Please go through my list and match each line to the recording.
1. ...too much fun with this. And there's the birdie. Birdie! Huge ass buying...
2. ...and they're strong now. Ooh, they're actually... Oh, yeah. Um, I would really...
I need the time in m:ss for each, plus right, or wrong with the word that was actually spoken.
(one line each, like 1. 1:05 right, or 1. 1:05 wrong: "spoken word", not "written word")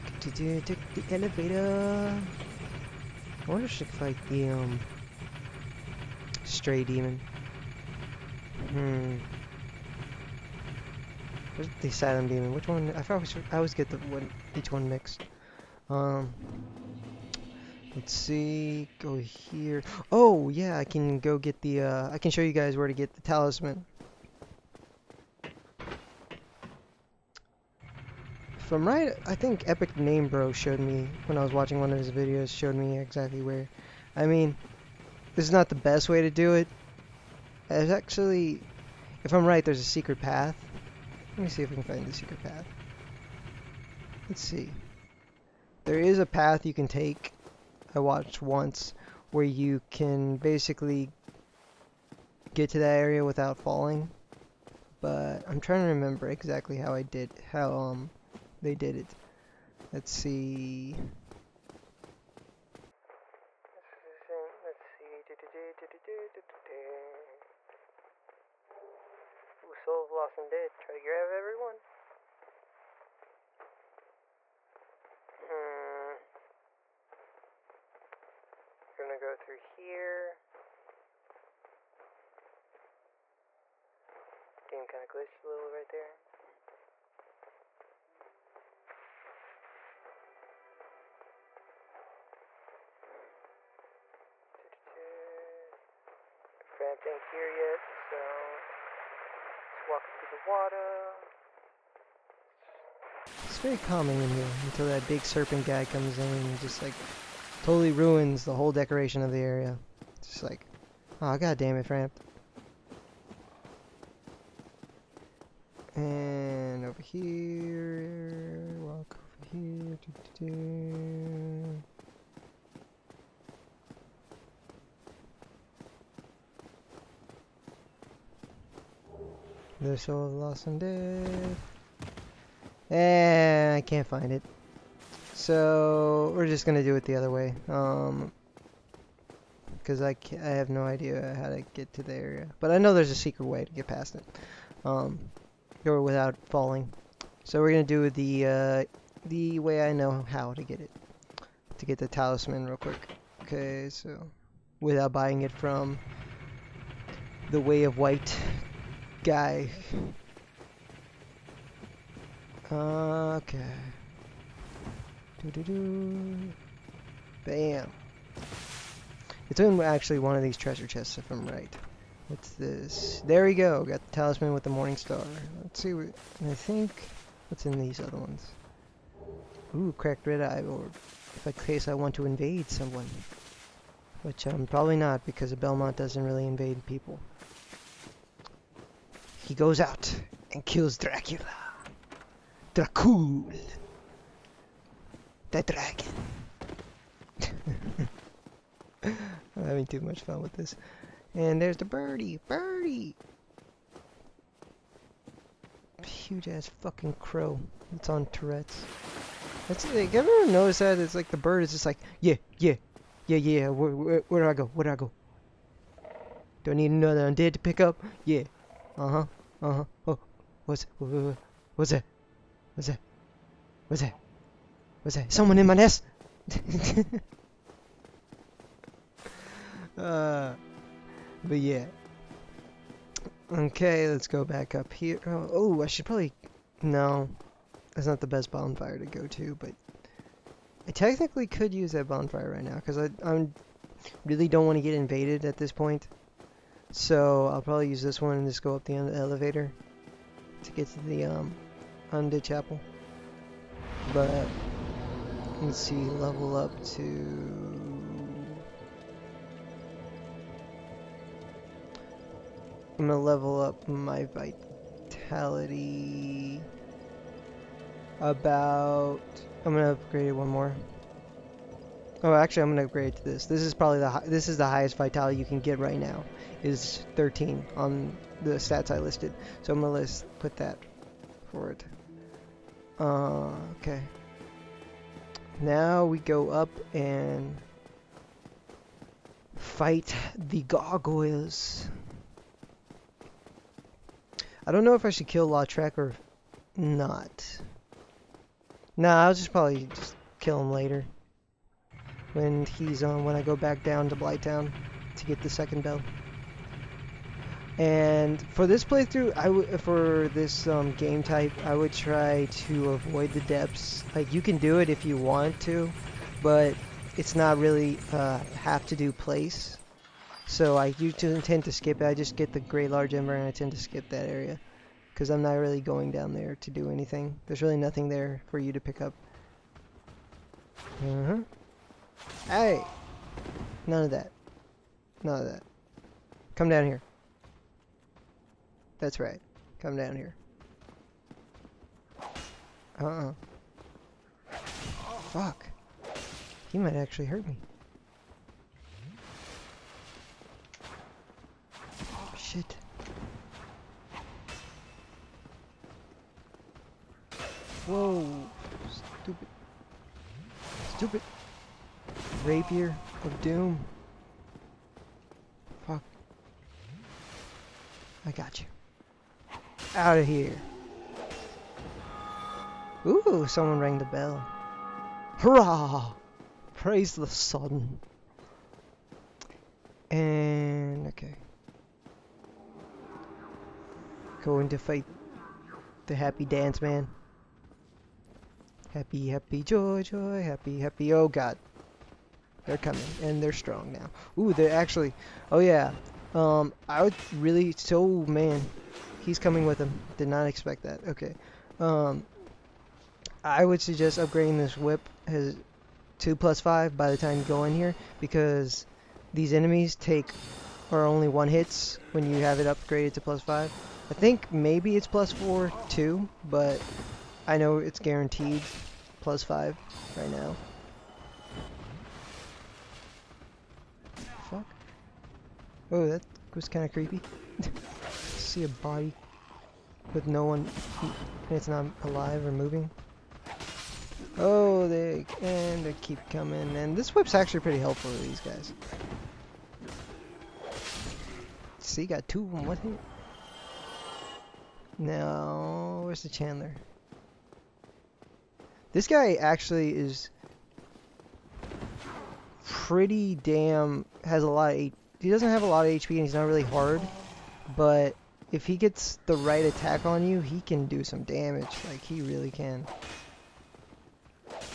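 1. 3:19 wrong: "fucking", not "buying"
2. 6:33 right.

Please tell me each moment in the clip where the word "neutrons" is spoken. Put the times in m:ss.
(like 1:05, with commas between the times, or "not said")
not said.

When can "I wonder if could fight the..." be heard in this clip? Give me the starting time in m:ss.
0:03.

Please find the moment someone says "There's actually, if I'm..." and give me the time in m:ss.
0:37.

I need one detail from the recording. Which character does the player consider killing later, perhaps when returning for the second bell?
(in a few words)
Lautrec.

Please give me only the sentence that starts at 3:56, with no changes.
No, that's not the best bonfire to go to, but...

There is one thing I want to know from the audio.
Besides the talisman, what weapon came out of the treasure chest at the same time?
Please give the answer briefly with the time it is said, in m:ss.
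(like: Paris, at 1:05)
Morning star, at 2:54.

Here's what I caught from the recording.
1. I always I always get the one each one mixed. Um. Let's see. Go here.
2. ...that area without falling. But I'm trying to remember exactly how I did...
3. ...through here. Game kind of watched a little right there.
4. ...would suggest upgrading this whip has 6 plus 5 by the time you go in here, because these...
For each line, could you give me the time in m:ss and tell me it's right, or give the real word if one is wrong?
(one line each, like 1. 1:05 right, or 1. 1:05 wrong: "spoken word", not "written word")
1. 0:12 right
2. 0:52 right
3. 1:19 wrong: "glitched", not "watched"
4. 6:43 wrong: "2", not "6".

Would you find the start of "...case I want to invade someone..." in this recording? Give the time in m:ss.
3:01.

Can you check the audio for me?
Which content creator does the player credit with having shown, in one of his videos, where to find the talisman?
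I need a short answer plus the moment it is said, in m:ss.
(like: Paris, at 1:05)
EpicNameBro, at 0:29.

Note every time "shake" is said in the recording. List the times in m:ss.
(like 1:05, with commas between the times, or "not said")
not said.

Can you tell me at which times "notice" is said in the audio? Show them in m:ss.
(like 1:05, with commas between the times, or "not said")
3:30.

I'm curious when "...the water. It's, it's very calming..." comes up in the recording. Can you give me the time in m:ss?
1:40.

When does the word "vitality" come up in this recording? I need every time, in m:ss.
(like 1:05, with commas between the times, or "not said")
4:24, 4:34.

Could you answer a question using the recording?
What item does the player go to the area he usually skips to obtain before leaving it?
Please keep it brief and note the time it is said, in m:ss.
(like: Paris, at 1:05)
Great large ember, at 5:22.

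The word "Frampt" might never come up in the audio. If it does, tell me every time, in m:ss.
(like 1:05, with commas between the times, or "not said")
1:36, 1:51.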